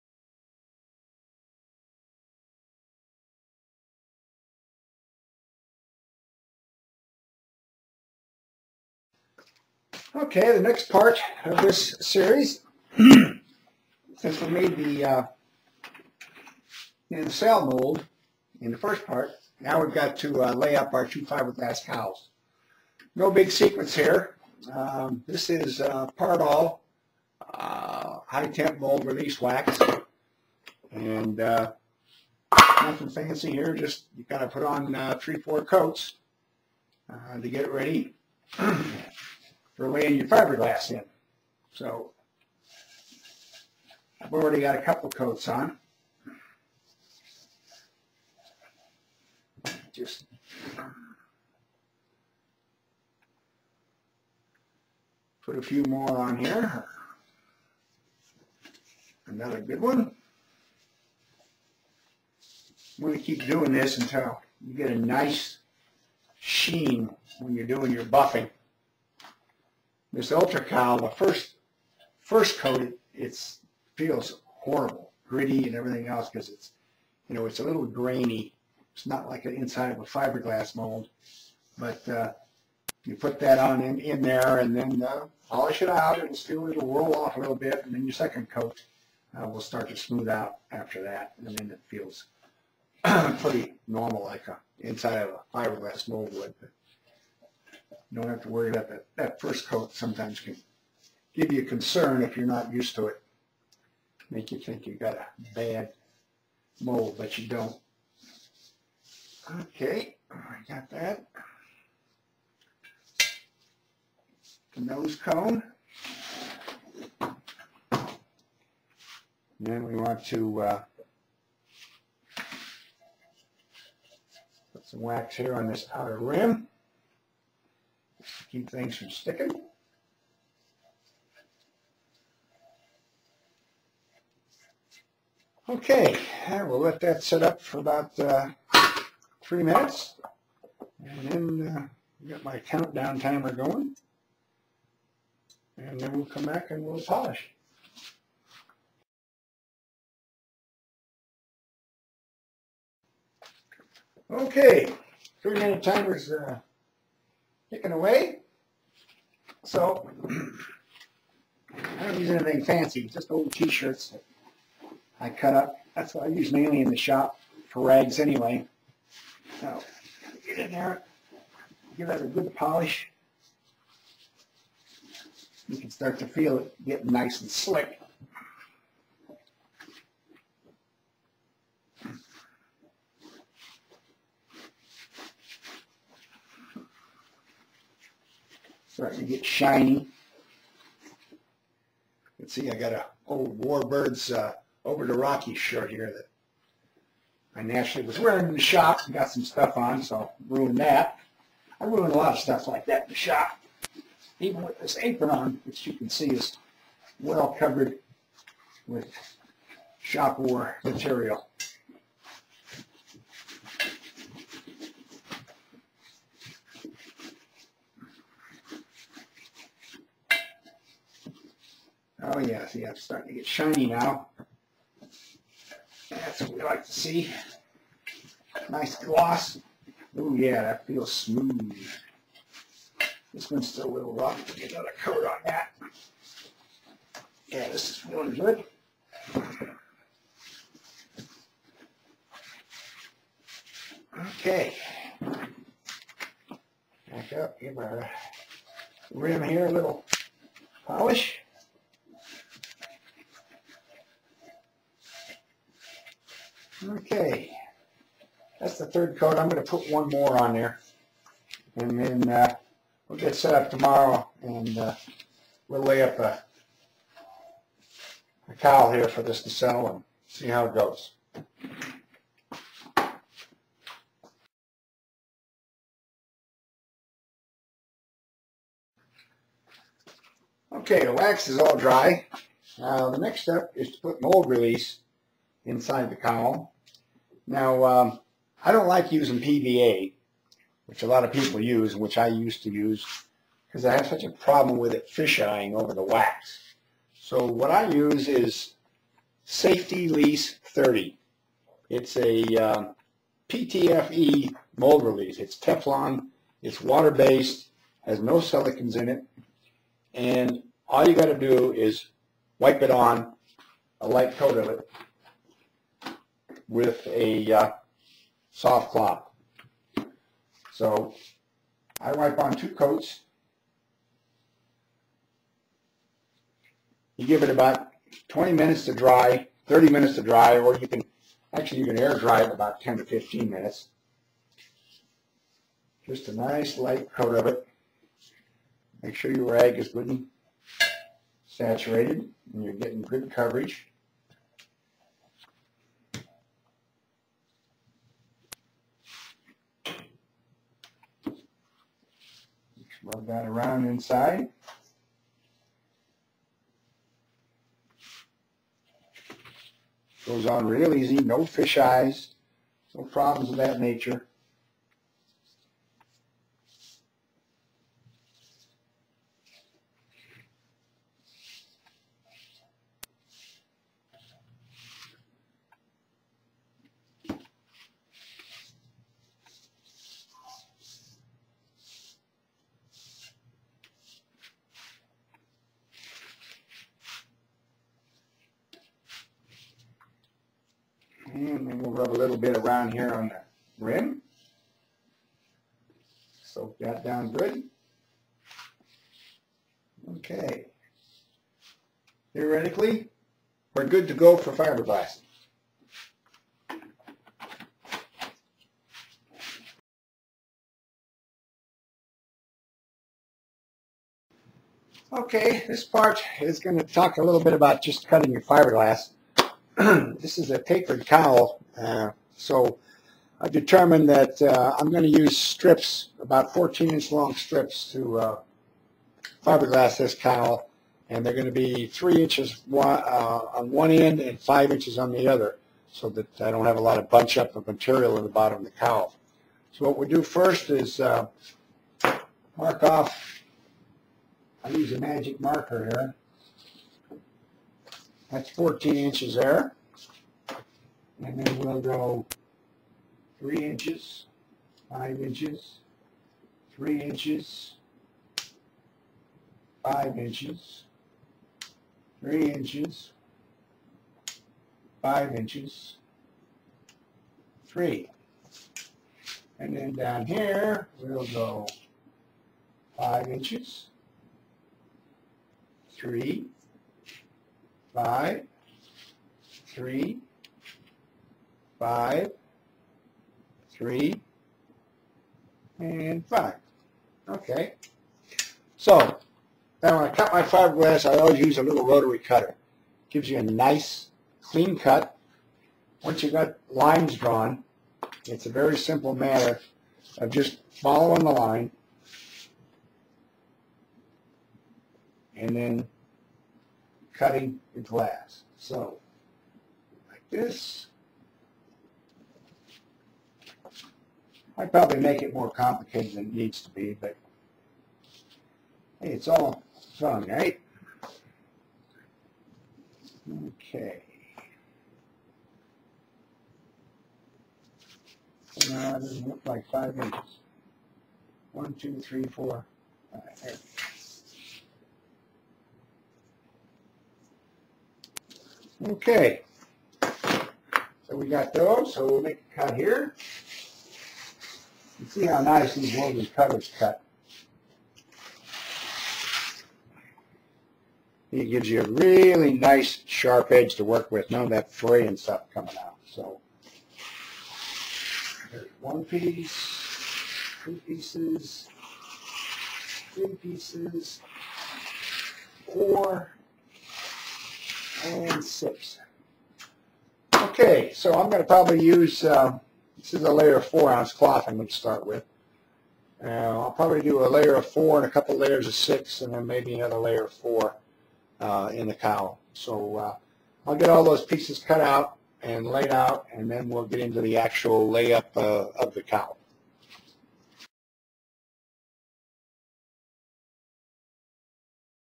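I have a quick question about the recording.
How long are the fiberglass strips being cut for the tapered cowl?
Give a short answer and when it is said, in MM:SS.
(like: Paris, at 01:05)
14 inches, at 07:06.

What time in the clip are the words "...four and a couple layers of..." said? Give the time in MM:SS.
09:37.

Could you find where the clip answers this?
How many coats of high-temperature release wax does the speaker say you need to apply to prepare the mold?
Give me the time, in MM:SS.
00:35.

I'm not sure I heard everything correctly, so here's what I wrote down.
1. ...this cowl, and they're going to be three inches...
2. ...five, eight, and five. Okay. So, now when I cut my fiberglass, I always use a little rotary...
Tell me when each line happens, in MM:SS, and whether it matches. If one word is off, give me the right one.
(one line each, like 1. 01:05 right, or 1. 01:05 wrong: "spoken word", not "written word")
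1. 07:09 right
2. 08:01 wrong: "three", not "eight".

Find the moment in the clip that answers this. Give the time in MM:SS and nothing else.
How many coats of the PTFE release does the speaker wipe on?
05:22.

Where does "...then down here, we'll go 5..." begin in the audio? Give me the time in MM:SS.
07:49.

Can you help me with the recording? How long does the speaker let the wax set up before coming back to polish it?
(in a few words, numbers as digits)
3 minutes.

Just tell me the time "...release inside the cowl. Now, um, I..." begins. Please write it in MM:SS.
04:44.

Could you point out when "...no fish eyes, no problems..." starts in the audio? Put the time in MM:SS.
06:01.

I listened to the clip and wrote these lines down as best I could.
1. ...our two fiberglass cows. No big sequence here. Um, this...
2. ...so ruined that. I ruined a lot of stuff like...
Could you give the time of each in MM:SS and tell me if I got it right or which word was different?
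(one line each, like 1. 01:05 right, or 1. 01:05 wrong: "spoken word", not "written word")
1. 00:20 right
2. 03:20 right.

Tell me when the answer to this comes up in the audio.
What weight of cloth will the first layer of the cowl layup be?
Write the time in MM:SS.
09:33.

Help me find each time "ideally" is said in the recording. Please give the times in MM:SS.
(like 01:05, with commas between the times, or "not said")
not said.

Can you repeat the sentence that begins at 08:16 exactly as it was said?
Once you've got lines drawn, it's a very simple matter of just following the line and then cutting the glass.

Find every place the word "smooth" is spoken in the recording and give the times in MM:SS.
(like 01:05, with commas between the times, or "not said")
01:29, 03:51.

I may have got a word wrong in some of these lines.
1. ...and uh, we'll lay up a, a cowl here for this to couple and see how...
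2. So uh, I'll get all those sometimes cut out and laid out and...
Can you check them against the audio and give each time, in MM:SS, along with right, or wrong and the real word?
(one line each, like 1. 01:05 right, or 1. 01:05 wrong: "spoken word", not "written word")
1. 04:24 wrong: "settle", not "couple"
2. 09:42 wrong: "pieces", not "sometimes".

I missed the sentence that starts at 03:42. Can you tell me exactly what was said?
Oh, yeah, see, I'm starting to get shiny now.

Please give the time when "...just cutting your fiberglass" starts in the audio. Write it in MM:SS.
06:57.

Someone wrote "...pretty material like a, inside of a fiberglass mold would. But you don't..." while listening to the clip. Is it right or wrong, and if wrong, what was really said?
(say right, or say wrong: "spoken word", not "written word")
wrong: "normal", not "material".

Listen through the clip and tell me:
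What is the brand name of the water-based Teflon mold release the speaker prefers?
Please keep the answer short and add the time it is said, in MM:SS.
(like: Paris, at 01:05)
Safelease 30, at 04:59.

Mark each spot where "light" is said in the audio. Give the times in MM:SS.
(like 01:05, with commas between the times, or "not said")
05:14, 05:36.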